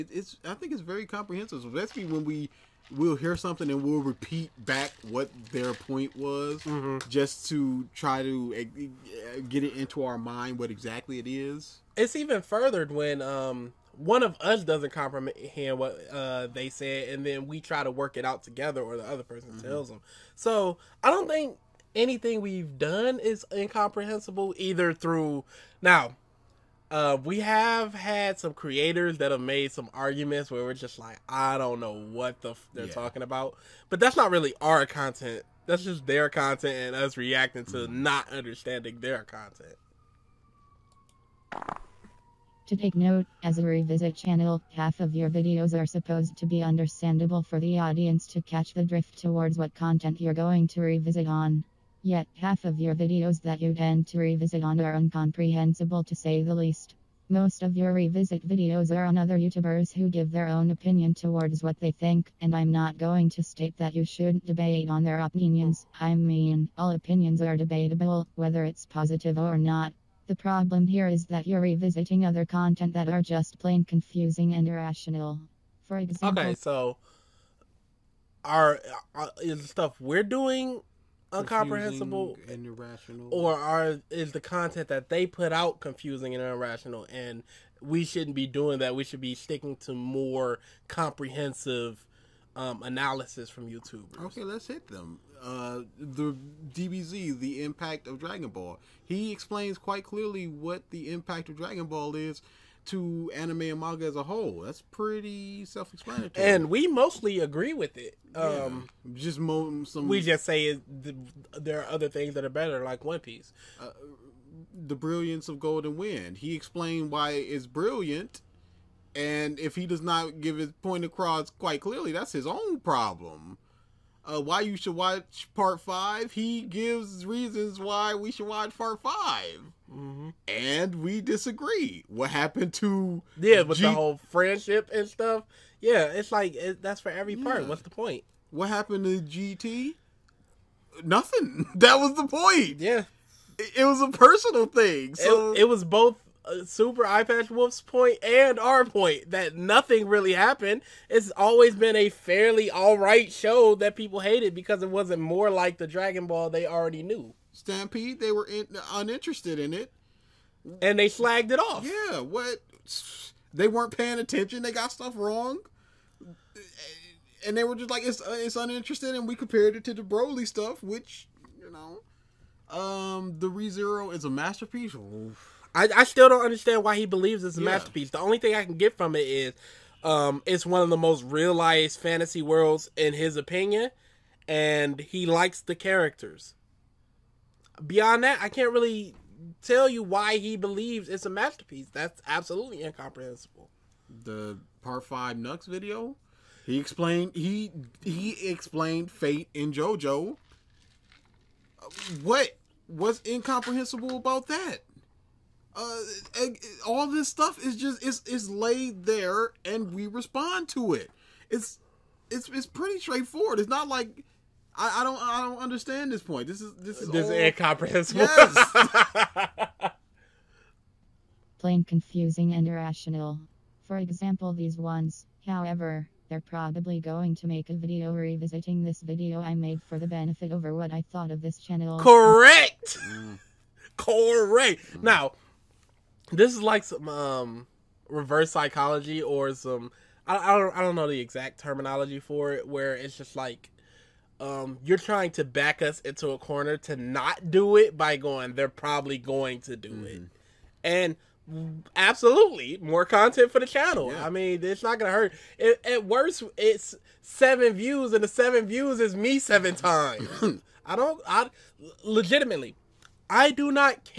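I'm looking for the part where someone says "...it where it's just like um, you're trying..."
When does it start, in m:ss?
4:02.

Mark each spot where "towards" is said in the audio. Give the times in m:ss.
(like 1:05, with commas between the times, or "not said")
0:49, 1:01.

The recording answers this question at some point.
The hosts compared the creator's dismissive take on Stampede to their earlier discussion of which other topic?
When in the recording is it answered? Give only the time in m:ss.
2:50.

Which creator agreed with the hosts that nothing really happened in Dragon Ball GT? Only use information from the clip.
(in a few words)
Super Eye Patch Wolf.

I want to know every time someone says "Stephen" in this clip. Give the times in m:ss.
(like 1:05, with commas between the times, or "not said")
not said.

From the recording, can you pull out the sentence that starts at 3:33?
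It's not like I, I don't I don't understand this point.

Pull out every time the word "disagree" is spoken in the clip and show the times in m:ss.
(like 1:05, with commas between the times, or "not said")
2:11.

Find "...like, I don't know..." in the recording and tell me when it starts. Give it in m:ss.
0:30.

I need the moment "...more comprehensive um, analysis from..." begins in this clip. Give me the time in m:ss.
1:29.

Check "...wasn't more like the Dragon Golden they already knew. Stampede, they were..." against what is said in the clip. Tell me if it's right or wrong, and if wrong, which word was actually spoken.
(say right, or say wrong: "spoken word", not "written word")
wrong: "Ball", not "Golden".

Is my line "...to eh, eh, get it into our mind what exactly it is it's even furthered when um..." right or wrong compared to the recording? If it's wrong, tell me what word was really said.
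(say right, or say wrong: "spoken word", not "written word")
right.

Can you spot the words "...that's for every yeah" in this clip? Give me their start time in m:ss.
2:16.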